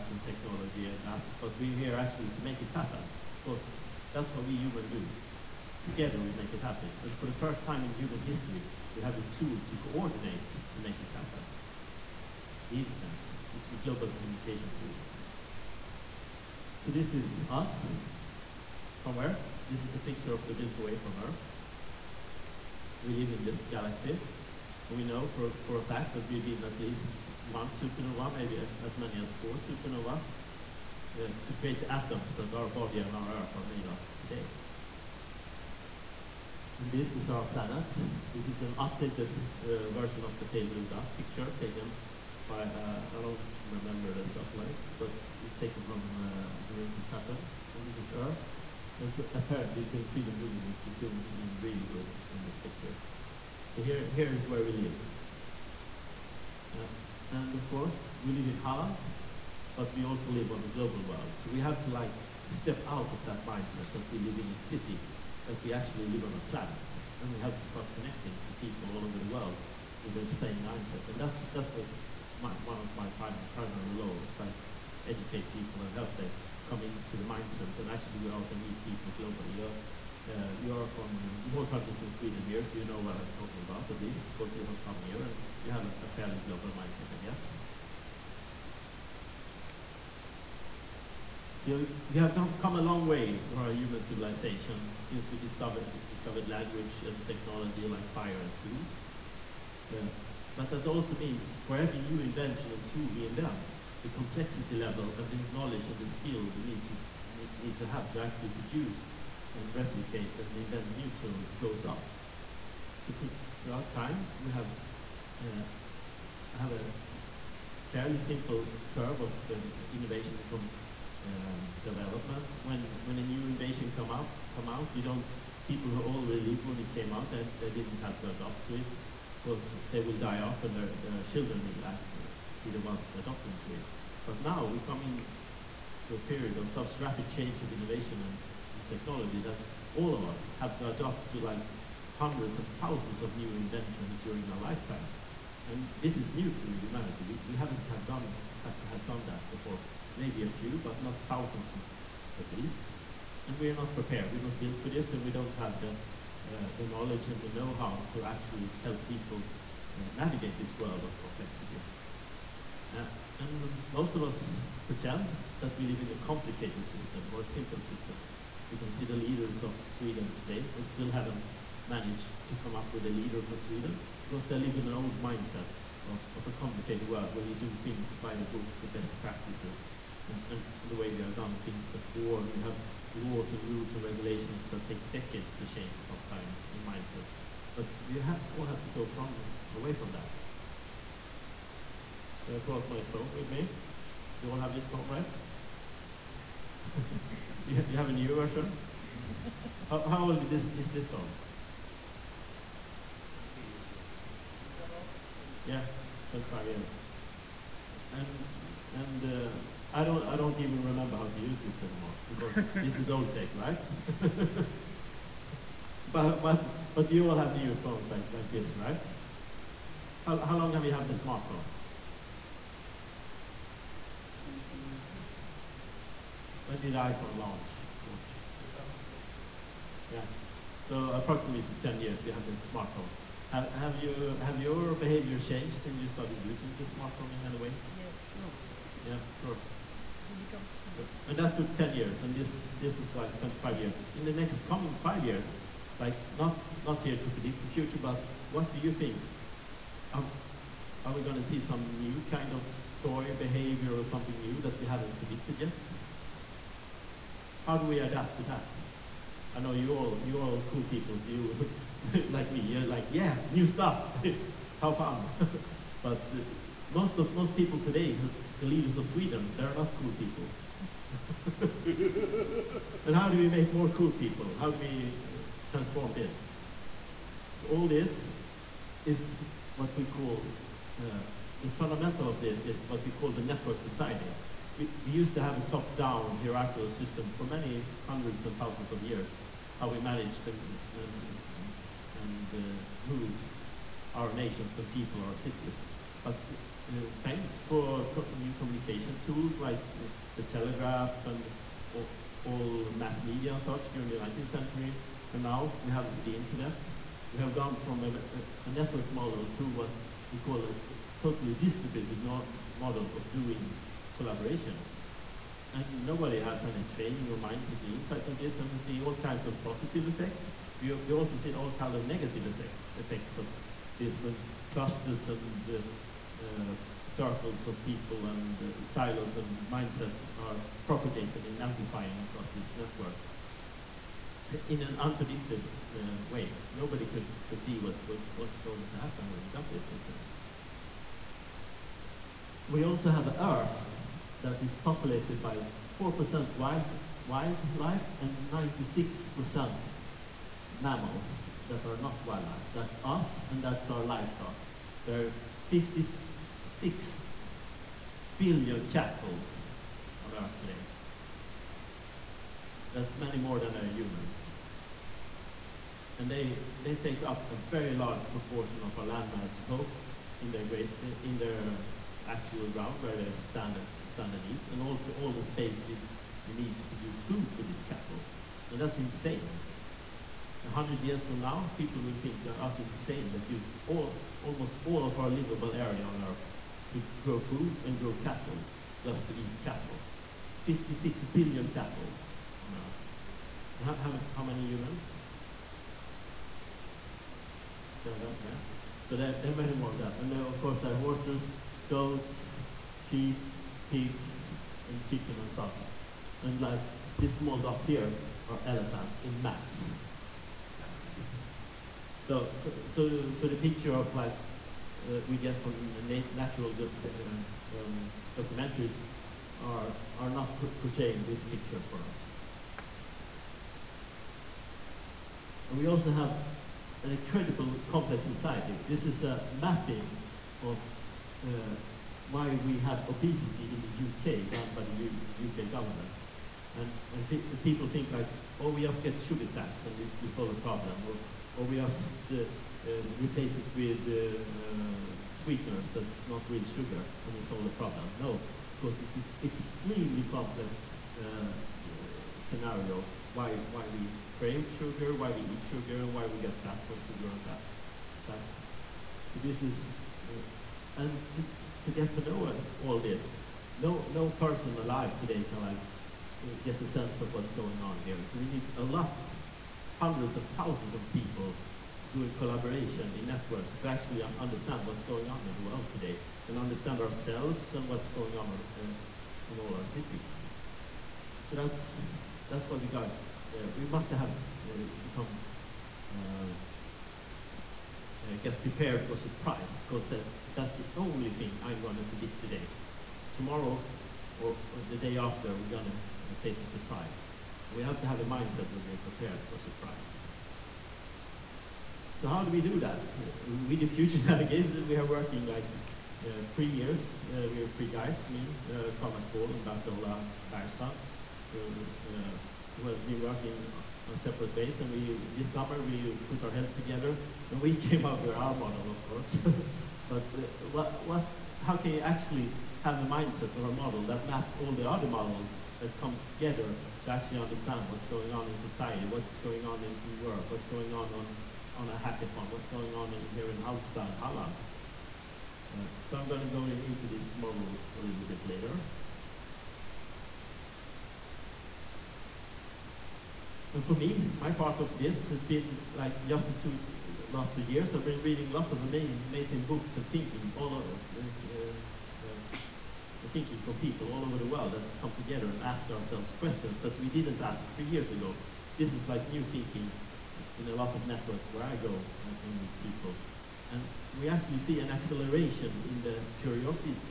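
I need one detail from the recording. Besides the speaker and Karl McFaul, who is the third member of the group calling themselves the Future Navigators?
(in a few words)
Bert-Ola Bergstrand.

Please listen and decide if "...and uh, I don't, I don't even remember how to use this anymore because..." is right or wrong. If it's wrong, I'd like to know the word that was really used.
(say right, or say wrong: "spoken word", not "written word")
right.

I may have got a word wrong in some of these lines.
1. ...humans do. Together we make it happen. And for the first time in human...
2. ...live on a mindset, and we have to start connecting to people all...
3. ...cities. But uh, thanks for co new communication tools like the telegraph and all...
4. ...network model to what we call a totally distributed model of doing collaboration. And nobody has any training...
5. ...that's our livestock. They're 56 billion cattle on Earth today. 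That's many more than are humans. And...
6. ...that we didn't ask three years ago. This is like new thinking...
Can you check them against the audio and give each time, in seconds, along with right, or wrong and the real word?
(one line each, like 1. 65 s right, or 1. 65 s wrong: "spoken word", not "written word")
1. 4 s right
2. 66 s wrong: "planet", not "mindset"
3. 295 s right
4. 308 s right
5. 353 s right
6. 556 s right.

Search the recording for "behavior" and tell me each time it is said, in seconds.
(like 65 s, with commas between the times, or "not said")
234 s, 253 s.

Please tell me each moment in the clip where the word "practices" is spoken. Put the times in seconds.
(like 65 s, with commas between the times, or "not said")
179 s.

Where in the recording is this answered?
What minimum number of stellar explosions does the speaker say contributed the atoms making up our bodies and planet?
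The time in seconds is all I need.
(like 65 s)
27 s.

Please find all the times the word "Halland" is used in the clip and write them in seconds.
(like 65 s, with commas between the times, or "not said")
58 s, 534 s.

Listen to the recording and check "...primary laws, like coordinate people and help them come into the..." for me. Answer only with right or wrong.
wrong.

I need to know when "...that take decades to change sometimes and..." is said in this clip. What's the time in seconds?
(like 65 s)
184 s.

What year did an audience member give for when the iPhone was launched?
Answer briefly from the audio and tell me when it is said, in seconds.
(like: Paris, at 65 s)
2006, at 228 s.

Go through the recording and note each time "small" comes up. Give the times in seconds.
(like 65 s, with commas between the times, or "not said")
407 s.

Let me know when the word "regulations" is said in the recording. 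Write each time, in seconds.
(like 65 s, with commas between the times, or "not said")
184 s.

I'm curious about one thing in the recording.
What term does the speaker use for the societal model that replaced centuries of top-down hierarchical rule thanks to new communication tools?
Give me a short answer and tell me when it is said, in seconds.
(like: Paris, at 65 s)
the network society, at 283 s.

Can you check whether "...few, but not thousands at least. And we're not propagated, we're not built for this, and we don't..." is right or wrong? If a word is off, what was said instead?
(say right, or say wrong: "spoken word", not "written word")
wrong: "prepared", not "propagated".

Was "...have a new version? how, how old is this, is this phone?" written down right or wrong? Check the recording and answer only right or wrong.
right.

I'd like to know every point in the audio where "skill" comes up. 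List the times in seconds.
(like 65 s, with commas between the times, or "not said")
106 s.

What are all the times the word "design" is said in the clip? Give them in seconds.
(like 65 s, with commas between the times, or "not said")
not said.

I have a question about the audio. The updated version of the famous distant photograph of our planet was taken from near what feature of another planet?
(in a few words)
the rings of Saturn.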